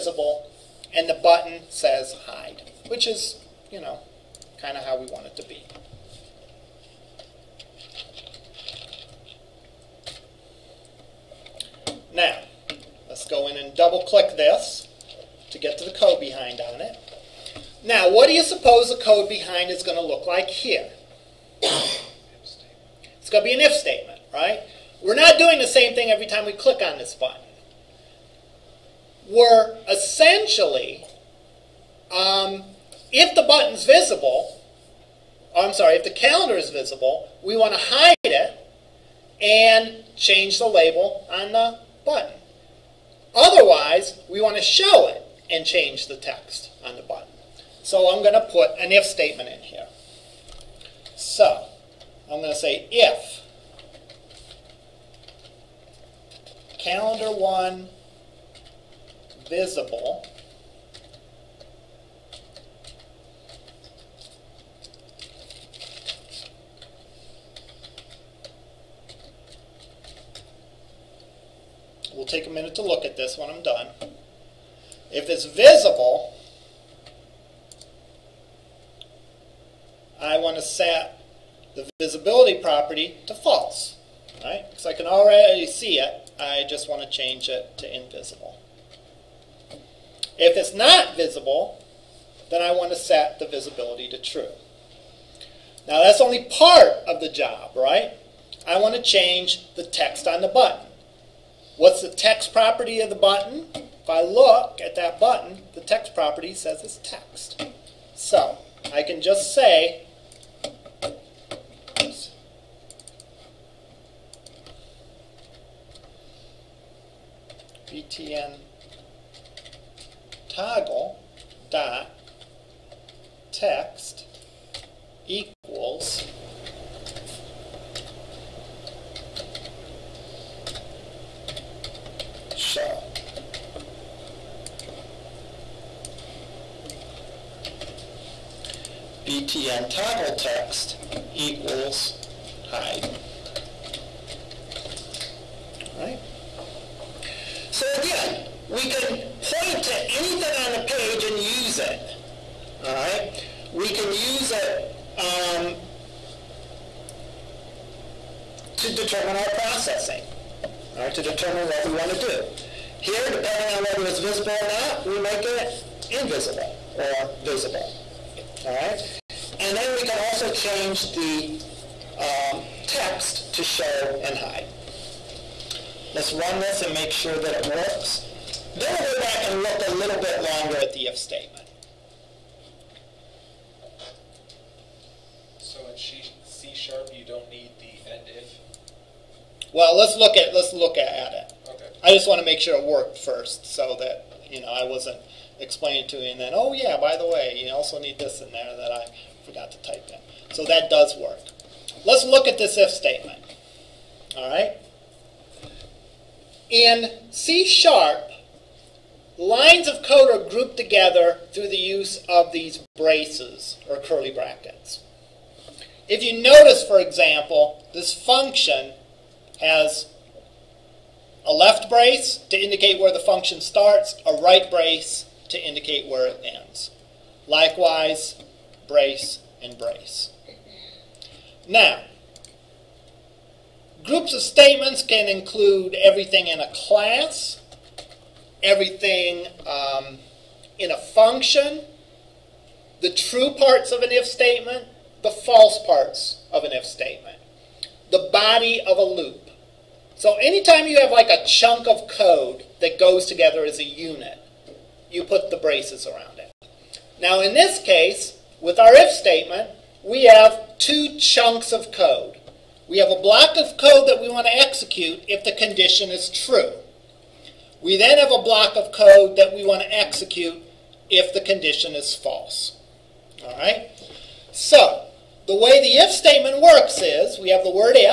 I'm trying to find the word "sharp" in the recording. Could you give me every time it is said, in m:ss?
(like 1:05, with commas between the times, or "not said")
3:06, 3:27.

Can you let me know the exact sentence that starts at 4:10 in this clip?
So anytime you have like a chunk of code that goes together as a unit, you put the braces around it.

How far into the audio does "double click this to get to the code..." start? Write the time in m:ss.
0:13.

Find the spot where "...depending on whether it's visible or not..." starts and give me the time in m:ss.
2:43.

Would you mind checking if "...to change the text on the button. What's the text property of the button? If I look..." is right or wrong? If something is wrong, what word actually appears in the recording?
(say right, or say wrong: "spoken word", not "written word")
right.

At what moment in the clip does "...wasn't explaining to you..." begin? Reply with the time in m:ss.
3:14.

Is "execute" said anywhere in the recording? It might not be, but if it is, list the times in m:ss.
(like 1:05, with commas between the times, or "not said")
4:24, 4:29.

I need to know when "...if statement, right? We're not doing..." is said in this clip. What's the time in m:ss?
0:23.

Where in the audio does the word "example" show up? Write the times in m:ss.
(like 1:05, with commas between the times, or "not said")
3:36.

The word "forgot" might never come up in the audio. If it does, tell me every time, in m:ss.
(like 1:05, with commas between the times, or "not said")
3:19.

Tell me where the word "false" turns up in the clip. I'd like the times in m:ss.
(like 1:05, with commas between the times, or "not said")
1:23, 4:05, 4:32.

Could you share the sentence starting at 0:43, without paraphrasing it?
Otherwise, we want to show it and change the text on the button.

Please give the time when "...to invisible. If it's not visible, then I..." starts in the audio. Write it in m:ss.
1:27.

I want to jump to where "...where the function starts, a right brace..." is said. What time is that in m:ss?
3:42.